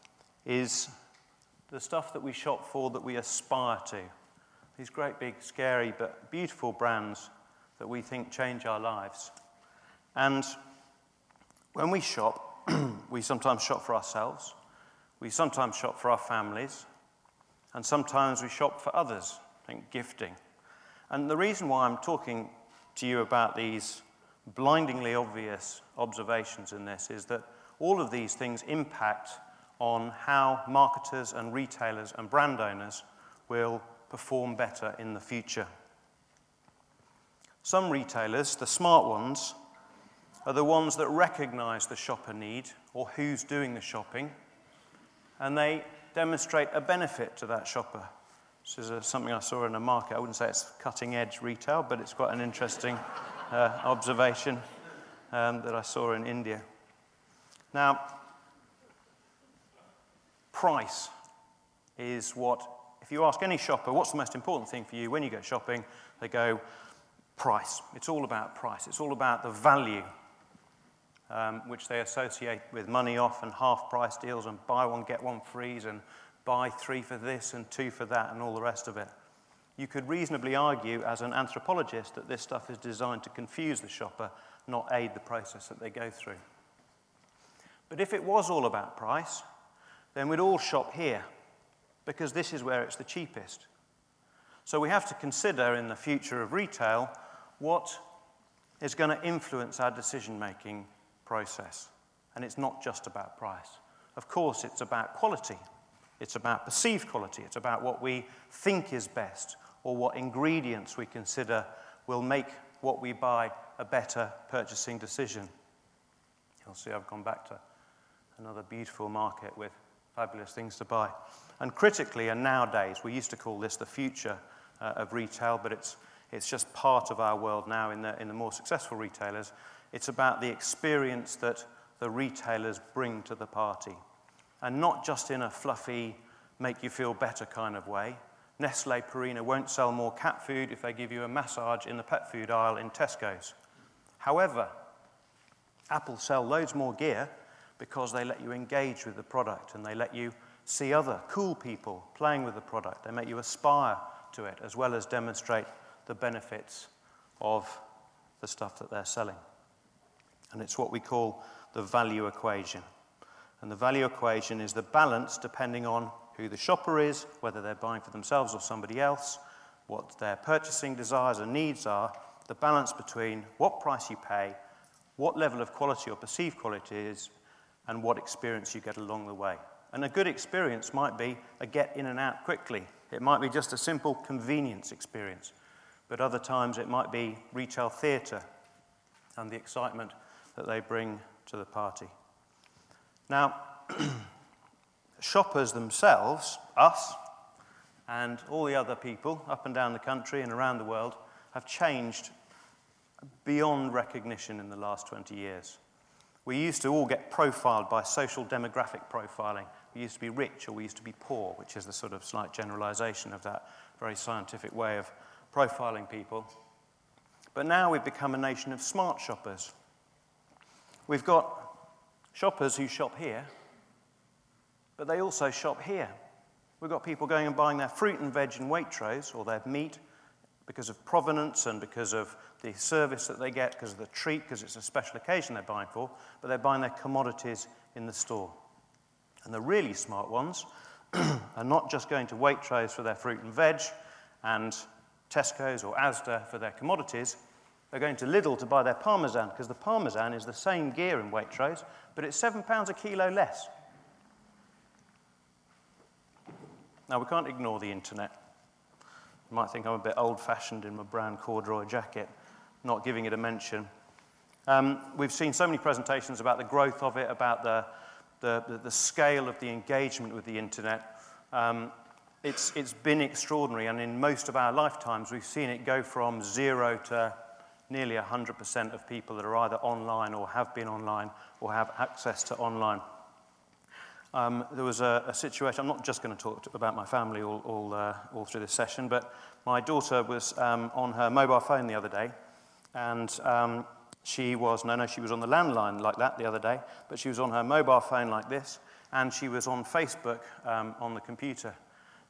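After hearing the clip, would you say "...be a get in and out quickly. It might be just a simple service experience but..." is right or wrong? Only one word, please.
wrong.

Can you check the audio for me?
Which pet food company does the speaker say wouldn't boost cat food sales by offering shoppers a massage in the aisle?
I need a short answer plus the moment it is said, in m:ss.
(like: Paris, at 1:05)
Nestle Purina, at 2:18.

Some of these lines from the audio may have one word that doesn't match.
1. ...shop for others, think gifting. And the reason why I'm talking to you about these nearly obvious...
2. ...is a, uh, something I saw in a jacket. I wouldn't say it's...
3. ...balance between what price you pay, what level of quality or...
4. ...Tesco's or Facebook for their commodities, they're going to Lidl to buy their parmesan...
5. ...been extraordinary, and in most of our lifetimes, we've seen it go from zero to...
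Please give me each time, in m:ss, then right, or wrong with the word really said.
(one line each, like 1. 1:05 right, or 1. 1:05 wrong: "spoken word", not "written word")
1. 0:18 wrong: "blindingly", not "nearly"
2. 0:48 wrong: "market", not "jacket"
3. 2:52 right
4. 4:05 wrong: "Asda", not "Facebook"
5. 4:32 right.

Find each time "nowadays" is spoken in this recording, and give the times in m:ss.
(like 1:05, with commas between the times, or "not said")
2:02.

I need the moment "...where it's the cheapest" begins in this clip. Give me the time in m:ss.
1:32.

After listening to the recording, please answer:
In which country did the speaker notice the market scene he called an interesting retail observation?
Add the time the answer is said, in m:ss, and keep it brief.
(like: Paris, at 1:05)
India, at 0:56.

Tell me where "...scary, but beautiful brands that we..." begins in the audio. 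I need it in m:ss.
0:05.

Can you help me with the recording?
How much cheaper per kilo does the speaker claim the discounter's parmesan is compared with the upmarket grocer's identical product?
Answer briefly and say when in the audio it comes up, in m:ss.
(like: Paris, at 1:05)
£7, at 4:12.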